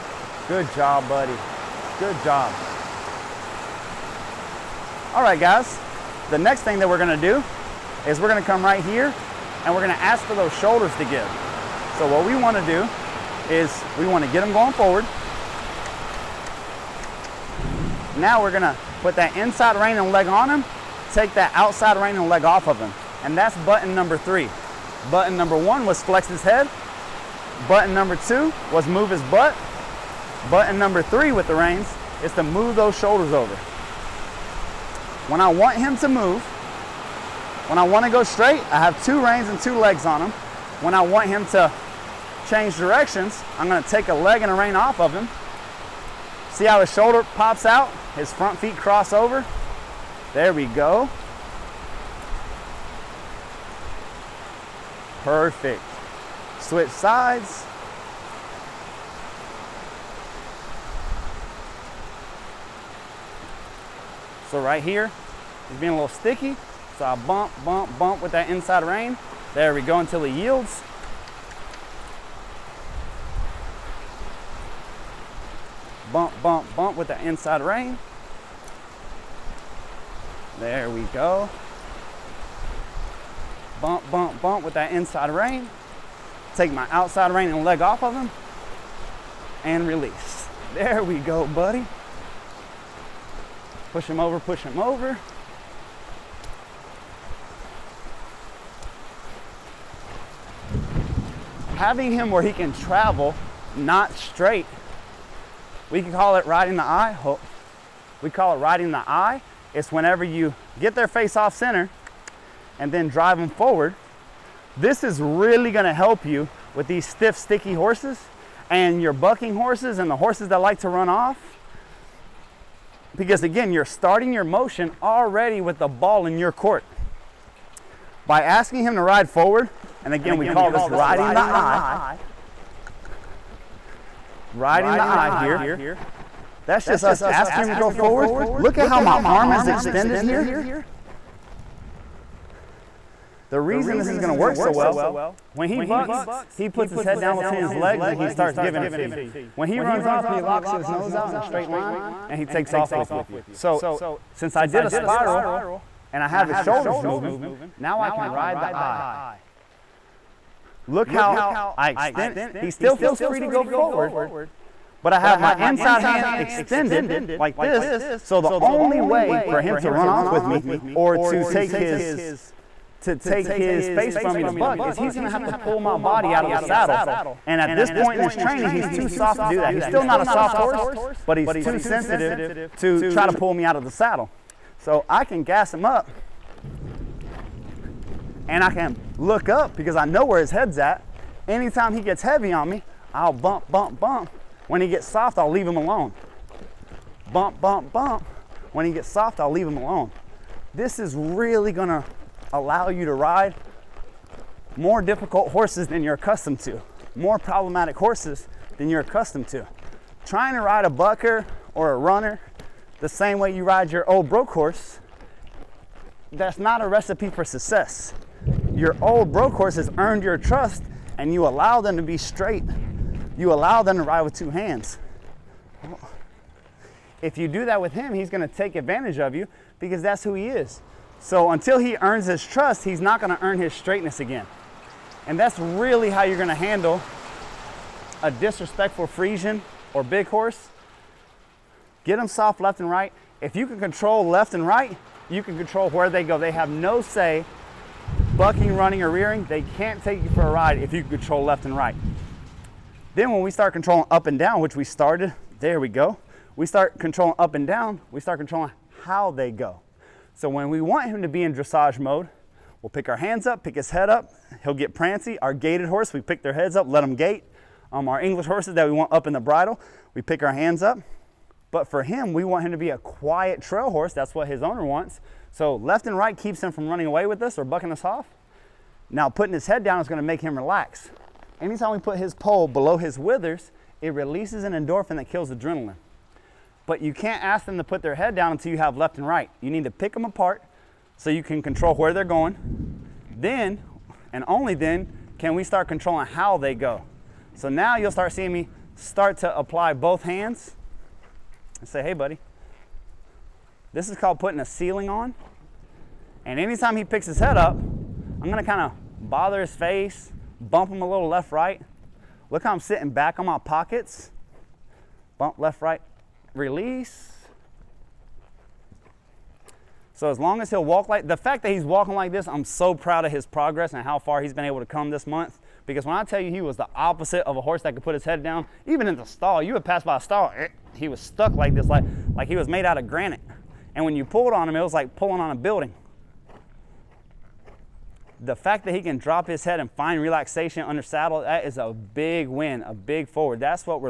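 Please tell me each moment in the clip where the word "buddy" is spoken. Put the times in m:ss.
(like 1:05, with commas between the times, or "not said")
0:01, 1:31, 5:02.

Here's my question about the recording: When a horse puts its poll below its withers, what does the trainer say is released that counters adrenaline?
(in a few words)
An endorphin.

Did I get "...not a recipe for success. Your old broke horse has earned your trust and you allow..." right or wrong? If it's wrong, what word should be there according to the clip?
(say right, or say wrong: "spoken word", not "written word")
right.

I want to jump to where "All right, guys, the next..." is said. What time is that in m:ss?
0:05.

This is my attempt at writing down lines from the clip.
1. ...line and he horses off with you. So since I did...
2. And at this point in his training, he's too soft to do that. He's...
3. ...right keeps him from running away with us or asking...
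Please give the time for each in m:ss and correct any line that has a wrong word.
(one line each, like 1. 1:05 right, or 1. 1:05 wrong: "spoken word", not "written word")
1. 2:31 wrong: "takes", not "horses"
2. 2:57 right
3. 4:36 wrong: "bucking", not "asking".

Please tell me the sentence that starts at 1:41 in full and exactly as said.
Having him where he can travel, not straight.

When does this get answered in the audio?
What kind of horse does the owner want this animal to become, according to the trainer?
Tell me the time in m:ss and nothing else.
4:32.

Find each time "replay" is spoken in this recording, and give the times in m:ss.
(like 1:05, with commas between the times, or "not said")
not said.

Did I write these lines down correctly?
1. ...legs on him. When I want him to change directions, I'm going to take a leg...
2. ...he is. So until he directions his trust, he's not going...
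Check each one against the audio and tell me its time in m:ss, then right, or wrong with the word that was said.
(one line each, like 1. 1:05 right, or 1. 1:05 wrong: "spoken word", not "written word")
1. 0:39 right
2. 3:50 wrong: "earns", not "directions".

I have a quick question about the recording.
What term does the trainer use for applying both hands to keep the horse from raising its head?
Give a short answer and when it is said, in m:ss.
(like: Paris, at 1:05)
Putting a ceiling on, at 5:04.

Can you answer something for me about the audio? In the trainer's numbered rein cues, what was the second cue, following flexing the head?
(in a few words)
Move his butt.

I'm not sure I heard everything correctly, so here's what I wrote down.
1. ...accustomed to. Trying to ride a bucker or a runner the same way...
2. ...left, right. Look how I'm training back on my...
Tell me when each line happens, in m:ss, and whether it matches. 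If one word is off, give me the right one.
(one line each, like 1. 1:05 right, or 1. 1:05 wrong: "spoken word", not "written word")
1. 3:29 right
2. 5:11 wrong: "sitting", not "training".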